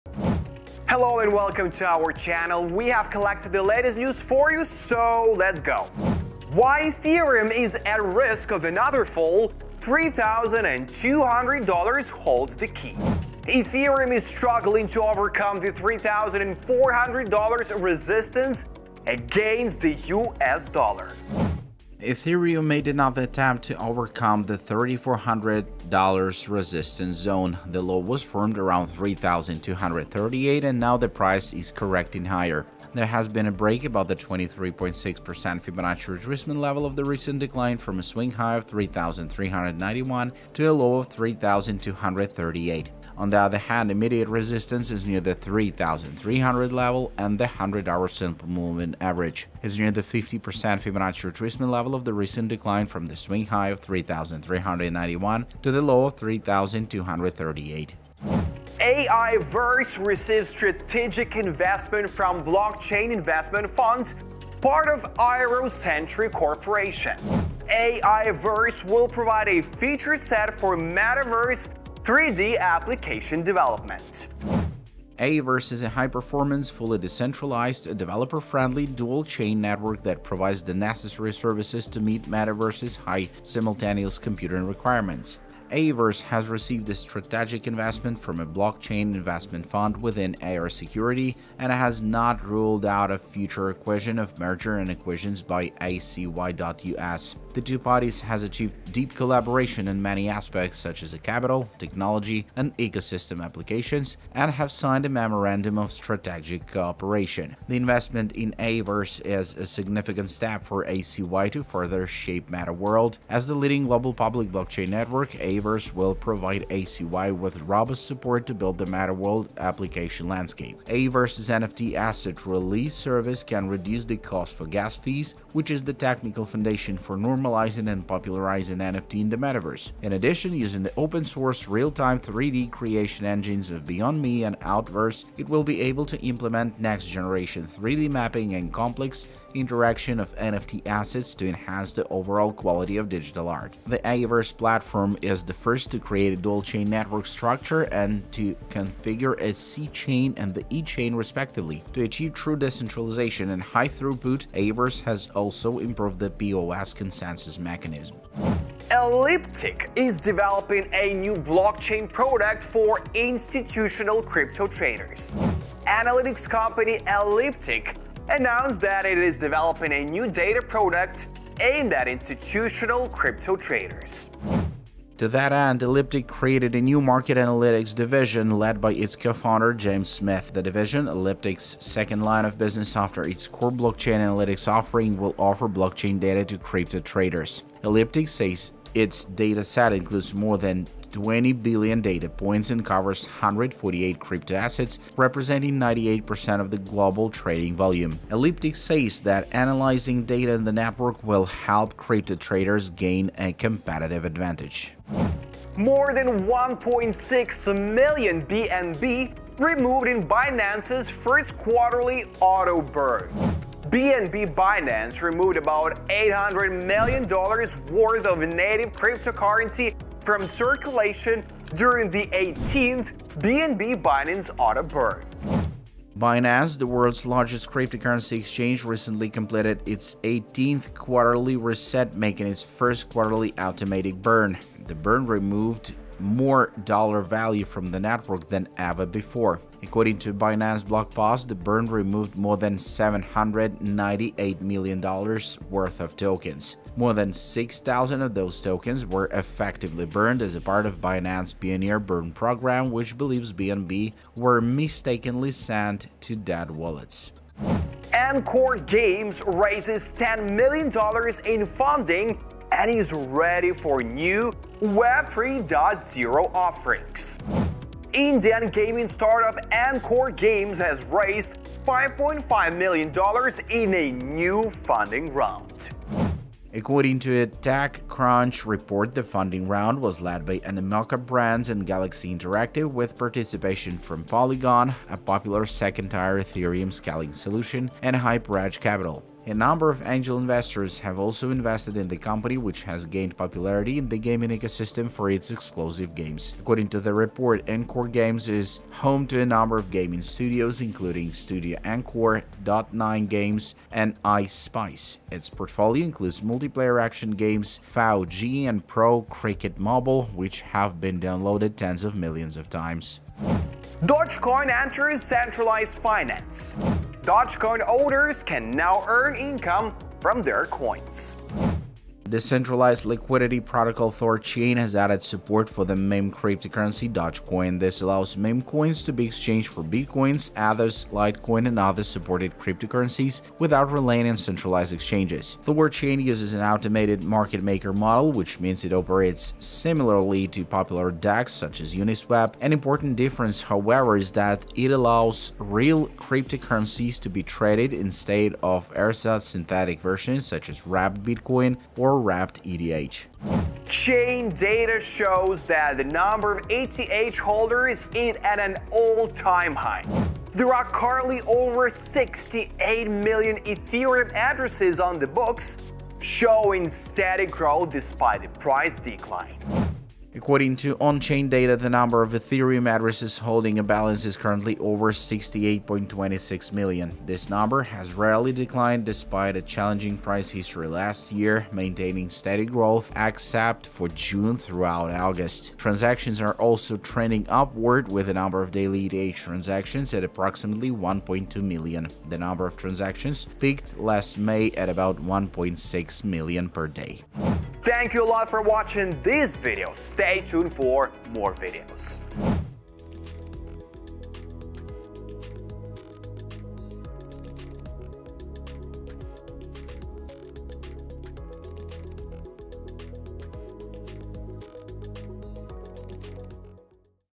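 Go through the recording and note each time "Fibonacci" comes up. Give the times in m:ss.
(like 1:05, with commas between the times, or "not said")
0:35, 0:50.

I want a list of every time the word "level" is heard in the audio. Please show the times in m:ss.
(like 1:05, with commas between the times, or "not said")
0:36, 0:46, 0:51.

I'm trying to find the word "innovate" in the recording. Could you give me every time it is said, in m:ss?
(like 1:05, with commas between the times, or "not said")
not said.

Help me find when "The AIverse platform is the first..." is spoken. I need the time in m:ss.
2:23.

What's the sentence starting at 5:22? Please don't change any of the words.
Decentralized Liquidity Protocol THORChain has added support for the meme cryptocurrency Dogecoin.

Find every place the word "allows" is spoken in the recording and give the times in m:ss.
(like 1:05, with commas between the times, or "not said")
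5:28, 5:44.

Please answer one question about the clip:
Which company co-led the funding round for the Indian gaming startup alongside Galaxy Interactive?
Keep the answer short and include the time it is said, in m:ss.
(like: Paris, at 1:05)
Animoca Brands, at 4:40.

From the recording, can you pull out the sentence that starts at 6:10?
According to on-chain data, the number of Ethereum addresses holding a balance is currently over 68.26 million.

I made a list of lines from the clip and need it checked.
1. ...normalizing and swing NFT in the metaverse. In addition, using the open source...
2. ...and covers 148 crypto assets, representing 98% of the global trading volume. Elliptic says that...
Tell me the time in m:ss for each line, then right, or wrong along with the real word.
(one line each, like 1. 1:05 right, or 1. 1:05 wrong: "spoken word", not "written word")
1. 2:07 wrong: "popularizing", not "swing"
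2. 3:12 right.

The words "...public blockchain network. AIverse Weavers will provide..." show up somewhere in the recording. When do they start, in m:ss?
1:54.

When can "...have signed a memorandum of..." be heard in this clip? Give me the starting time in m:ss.
1:44.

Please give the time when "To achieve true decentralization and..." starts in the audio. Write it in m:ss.
2:31.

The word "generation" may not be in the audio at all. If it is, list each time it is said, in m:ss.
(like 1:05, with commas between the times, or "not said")
2:16.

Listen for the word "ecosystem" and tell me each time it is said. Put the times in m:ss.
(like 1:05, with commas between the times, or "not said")
1:42, 4:54.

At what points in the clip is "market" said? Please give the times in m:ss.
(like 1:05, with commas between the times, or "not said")
2:57, 5:37.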